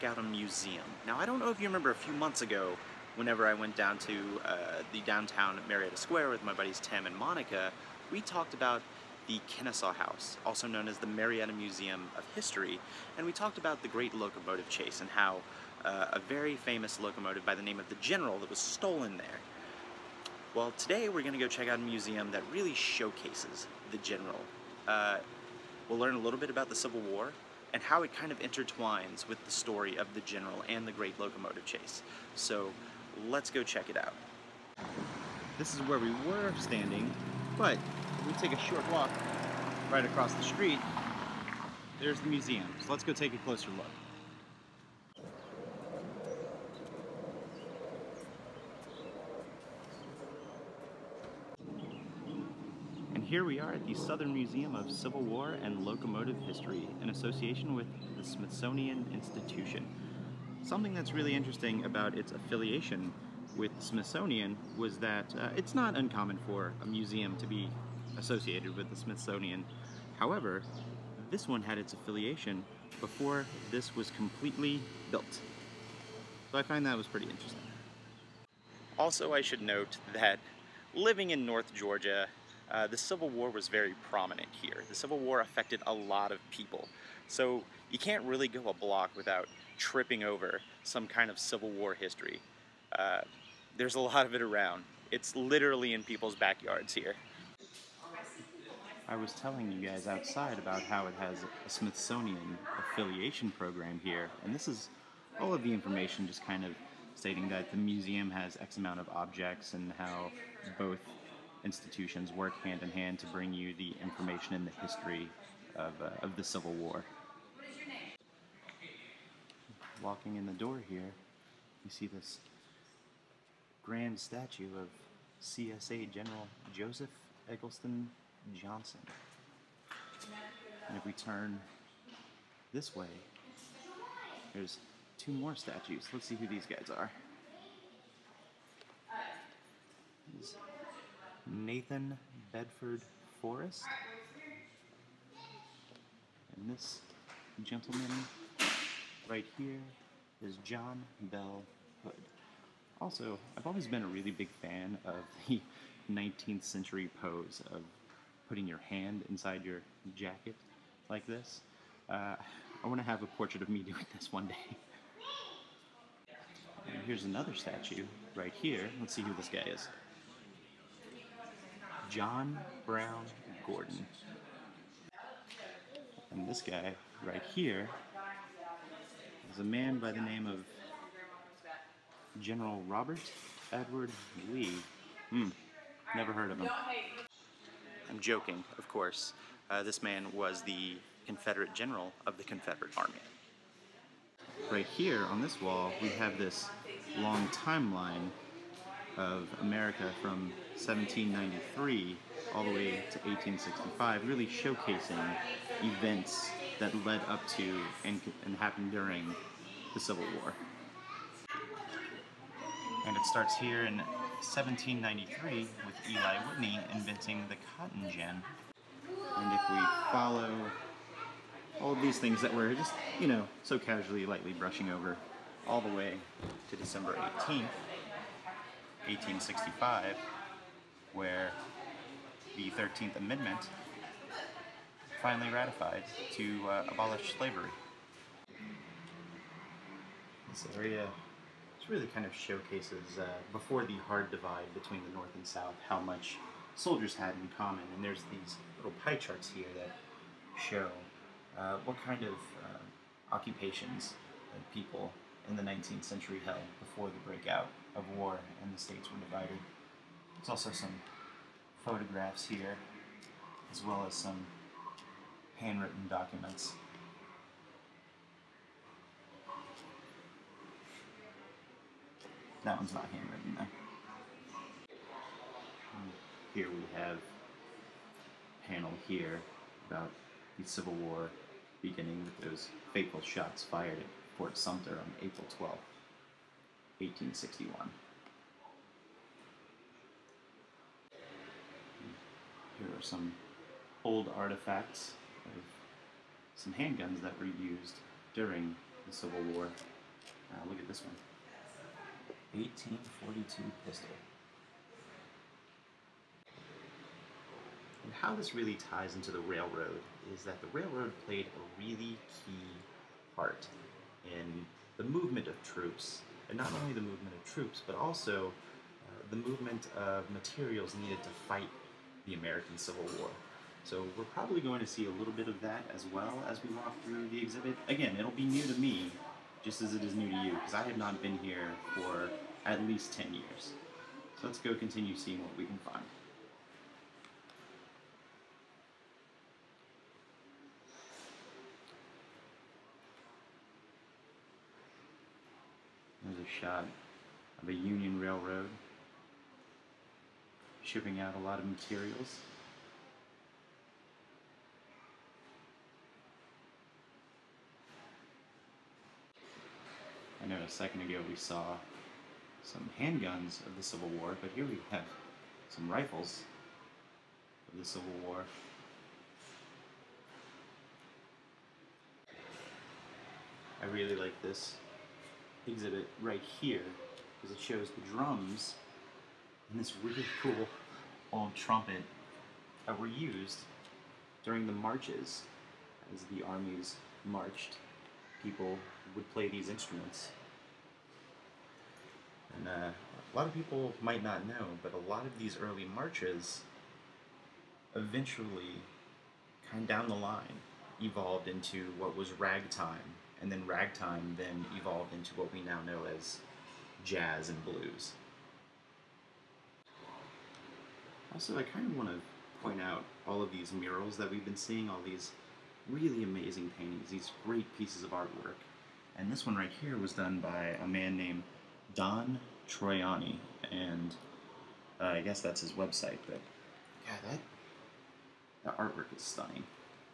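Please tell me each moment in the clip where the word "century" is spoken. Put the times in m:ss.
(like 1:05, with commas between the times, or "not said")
2:36, 4:16.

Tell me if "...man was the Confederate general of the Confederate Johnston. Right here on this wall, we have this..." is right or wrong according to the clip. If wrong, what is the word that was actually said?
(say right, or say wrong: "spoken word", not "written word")
wrong: "Army", not "Johnston".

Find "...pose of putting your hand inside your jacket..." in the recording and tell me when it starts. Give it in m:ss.
2:37.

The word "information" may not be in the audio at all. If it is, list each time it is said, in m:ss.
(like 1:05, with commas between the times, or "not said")
1:45, 1:54.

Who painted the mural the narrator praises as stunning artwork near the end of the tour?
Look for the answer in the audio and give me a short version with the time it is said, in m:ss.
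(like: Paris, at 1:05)
Don Troiani, at 7:01.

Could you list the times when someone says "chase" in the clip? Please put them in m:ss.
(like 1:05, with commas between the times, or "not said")
0:14, 0:31.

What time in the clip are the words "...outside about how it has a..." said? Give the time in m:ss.
1:40.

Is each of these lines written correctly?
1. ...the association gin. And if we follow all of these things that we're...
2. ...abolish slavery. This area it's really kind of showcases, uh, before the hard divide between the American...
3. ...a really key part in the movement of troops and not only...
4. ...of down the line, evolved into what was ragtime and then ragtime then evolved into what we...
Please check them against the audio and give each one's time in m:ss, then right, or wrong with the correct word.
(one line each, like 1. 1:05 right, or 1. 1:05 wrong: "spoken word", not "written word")
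1. 3:37 wrong: "cotton", not "association"
2. 3:56 wrong: "North", not "American"
3. 5:11 right
4. 6:39 right.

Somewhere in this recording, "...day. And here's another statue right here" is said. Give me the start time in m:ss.
2:44.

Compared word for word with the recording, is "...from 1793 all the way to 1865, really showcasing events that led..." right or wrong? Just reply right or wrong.
right.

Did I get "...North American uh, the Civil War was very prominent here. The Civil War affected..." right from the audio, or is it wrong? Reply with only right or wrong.
wrong.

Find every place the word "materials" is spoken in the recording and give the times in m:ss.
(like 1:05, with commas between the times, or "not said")
5:20, 5:51.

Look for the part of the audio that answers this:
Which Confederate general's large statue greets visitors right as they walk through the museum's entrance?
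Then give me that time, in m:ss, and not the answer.
2:06.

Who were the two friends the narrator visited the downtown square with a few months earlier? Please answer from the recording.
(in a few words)
Tim and Monica.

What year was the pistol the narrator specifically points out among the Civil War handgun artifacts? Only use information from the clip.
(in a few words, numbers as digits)
1842.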